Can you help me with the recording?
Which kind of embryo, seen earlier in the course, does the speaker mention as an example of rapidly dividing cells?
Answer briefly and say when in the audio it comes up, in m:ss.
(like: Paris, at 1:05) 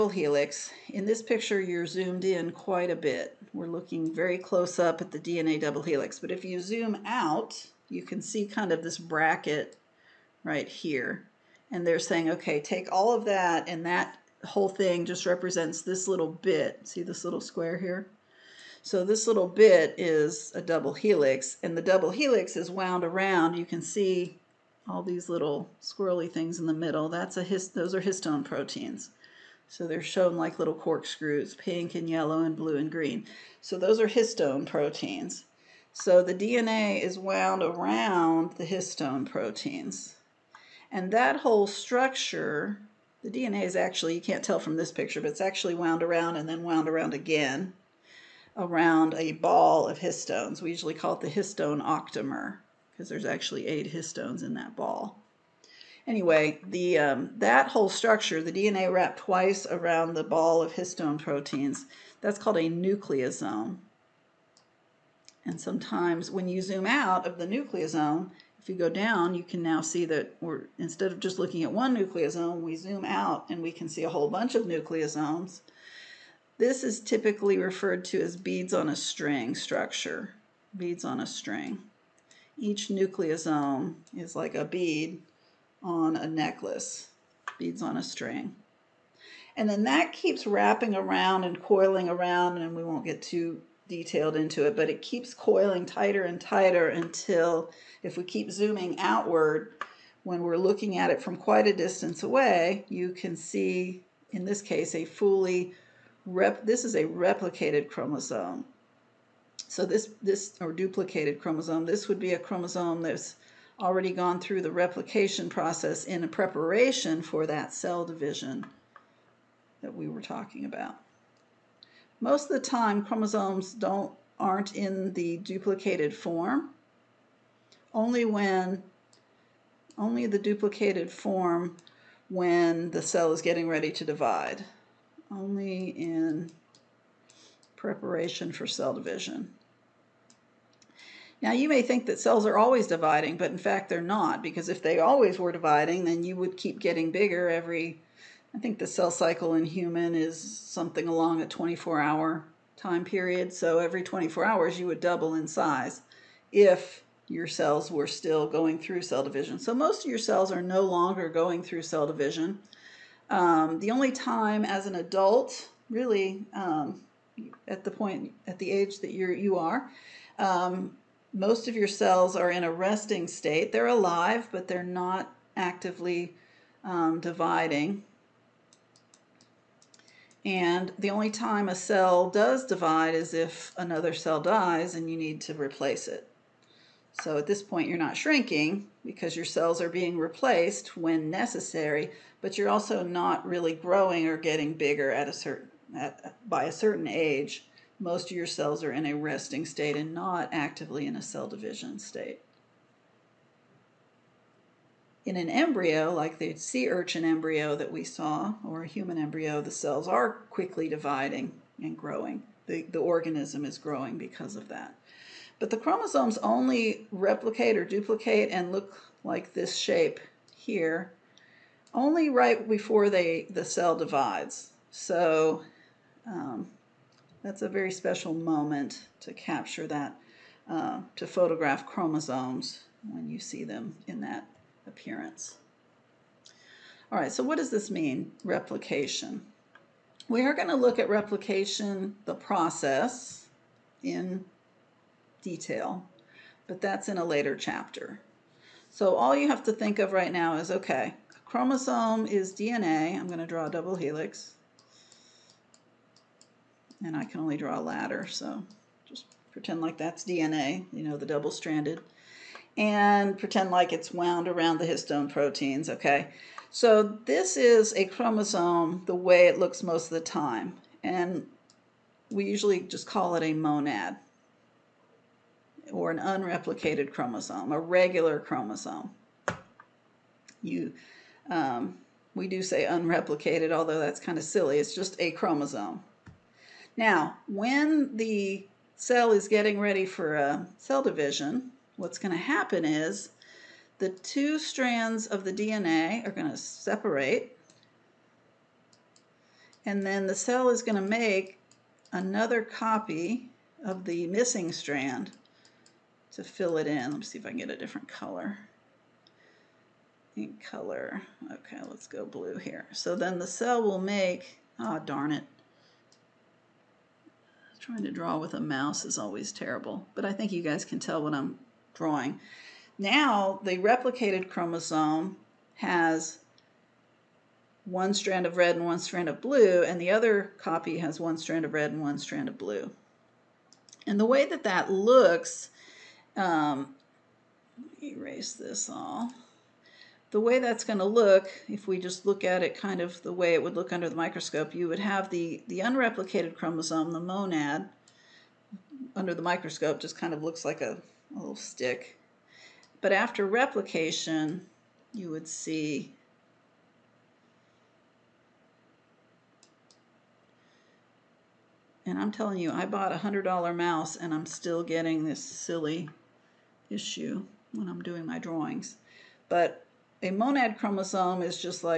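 sea urchin, at 3:26.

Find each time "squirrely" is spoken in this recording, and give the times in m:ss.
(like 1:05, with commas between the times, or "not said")
0:25.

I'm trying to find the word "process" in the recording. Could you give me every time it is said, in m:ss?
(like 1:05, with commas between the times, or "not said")
1:55, 4:02.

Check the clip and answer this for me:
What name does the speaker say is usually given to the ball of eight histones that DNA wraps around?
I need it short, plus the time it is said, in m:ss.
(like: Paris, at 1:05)
histone octamer, at 0:51.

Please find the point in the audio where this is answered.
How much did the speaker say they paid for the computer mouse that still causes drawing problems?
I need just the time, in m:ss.
6:03.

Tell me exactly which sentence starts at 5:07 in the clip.
Let me see if I can get a different color.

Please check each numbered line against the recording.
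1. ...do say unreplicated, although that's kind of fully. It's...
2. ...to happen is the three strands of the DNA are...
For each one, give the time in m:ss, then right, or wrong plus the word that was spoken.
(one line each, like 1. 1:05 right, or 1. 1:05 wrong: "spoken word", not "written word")
1. 4:42 wrong: "silly", not "fully"
2. 4:52 wrong: "two", not "three".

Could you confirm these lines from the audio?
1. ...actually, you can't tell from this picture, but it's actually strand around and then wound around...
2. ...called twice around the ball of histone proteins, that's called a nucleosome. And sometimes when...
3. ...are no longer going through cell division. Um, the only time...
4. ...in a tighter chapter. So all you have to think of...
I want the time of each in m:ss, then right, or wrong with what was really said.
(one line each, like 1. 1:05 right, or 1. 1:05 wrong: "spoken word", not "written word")
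1. 0:43 wrong: "wound", not "strand"
2. 0:58 wrong: "wrapped", not "called"
3. 2:40 right
4. 4:07 wrong: "later", not "tighter".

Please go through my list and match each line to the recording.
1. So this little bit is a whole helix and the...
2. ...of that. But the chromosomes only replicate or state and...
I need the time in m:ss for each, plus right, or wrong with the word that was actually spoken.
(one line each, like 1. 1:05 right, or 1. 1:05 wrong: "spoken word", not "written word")
1. 0:18 wrong: "double", not "whole"
2. 3:34 wrong: "duplicate", not "state".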